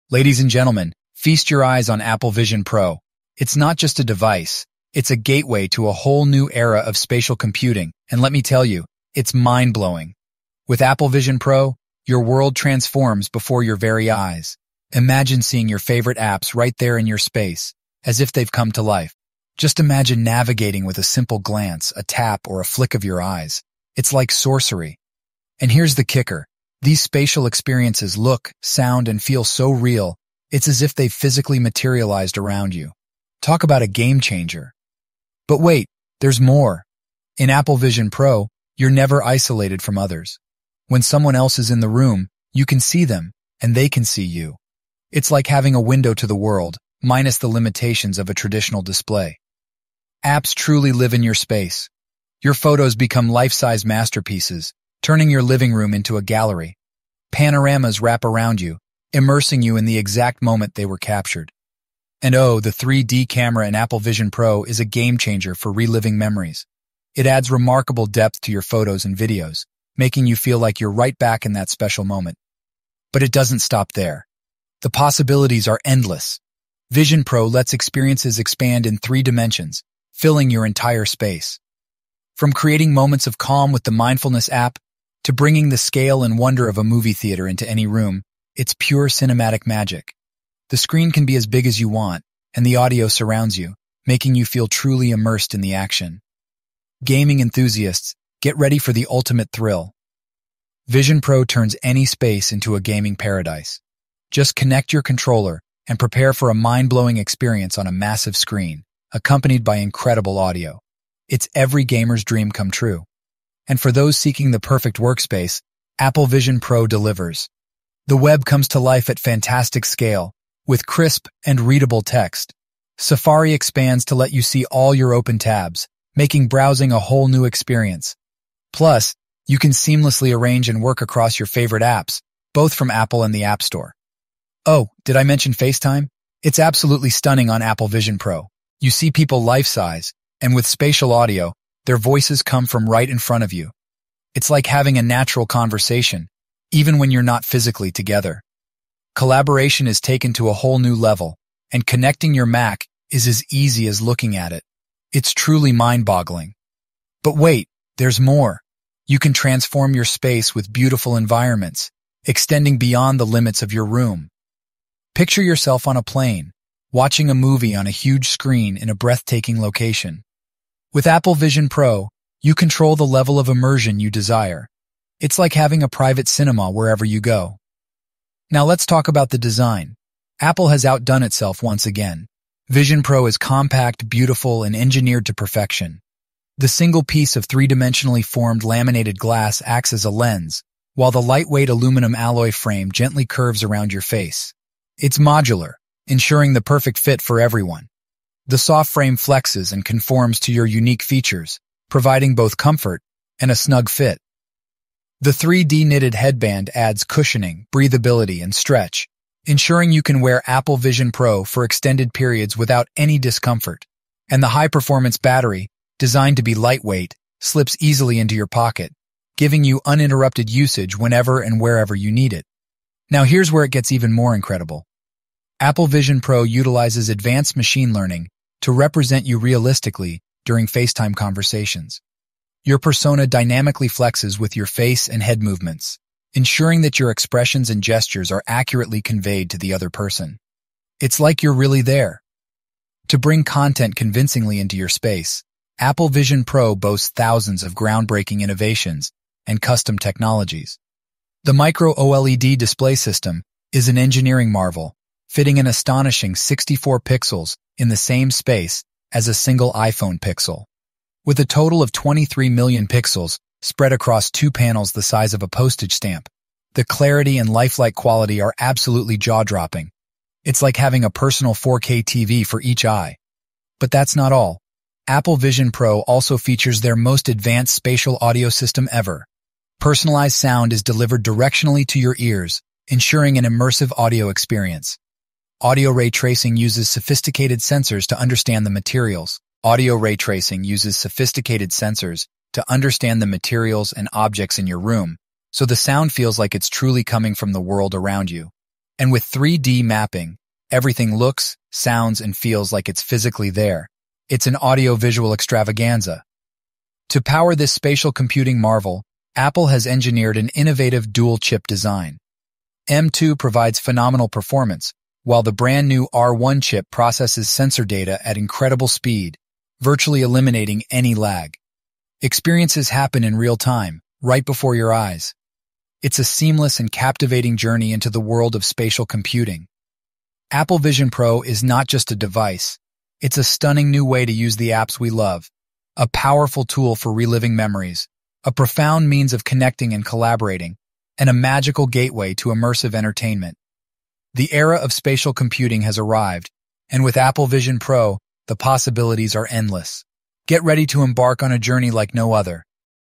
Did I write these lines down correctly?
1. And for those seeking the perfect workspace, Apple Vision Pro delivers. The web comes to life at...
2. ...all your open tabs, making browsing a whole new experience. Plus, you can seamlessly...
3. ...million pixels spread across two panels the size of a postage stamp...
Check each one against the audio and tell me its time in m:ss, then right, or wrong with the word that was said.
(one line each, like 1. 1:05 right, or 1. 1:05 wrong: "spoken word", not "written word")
1. 1:53 right
2. 2:04 right
3. 4:22 right.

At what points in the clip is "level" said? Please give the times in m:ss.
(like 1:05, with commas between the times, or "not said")
2:30, 2:53.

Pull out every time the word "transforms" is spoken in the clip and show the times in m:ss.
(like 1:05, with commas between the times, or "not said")
0:12, 2:39.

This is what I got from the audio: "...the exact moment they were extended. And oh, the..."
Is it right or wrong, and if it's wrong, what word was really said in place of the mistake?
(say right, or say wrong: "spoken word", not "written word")
wrong: "captured", not "extended".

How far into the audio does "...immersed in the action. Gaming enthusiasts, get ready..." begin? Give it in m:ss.
1:35.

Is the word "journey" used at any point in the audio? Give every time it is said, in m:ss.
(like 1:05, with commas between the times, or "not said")
5:27, 5:51.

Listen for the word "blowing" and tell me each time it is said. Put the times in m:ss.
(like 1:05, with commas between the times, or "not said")
0:09, 1:46.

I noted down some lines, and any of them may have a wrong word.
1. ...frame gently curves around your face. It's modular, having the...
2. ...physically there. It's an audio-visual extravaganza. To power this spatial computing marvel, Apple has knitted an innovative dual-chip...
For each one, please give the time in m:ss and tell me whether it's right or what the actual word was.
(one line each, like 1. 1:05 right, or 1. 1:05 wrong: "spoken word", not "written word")
1. 3:12 wrong: "ensuring", not "having"
2. 5:03 wrong: "engineered", not "knitted".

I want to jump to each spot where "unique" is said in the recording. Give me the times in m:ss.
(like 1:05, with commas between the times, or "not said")
3:20.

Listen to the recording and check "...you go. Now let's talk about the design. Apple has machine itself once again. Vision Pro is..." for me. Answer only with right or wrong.
wrong.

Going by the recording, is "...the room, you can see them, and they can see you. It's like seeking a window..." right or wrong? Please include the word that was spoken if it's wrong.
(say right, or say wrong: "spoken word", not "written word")
wrong: "having", not "seeking".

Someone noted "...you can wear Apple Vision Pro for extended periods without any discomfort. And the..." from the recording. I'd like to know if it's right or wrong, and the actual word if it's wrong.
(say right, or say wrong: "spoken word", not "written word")
right.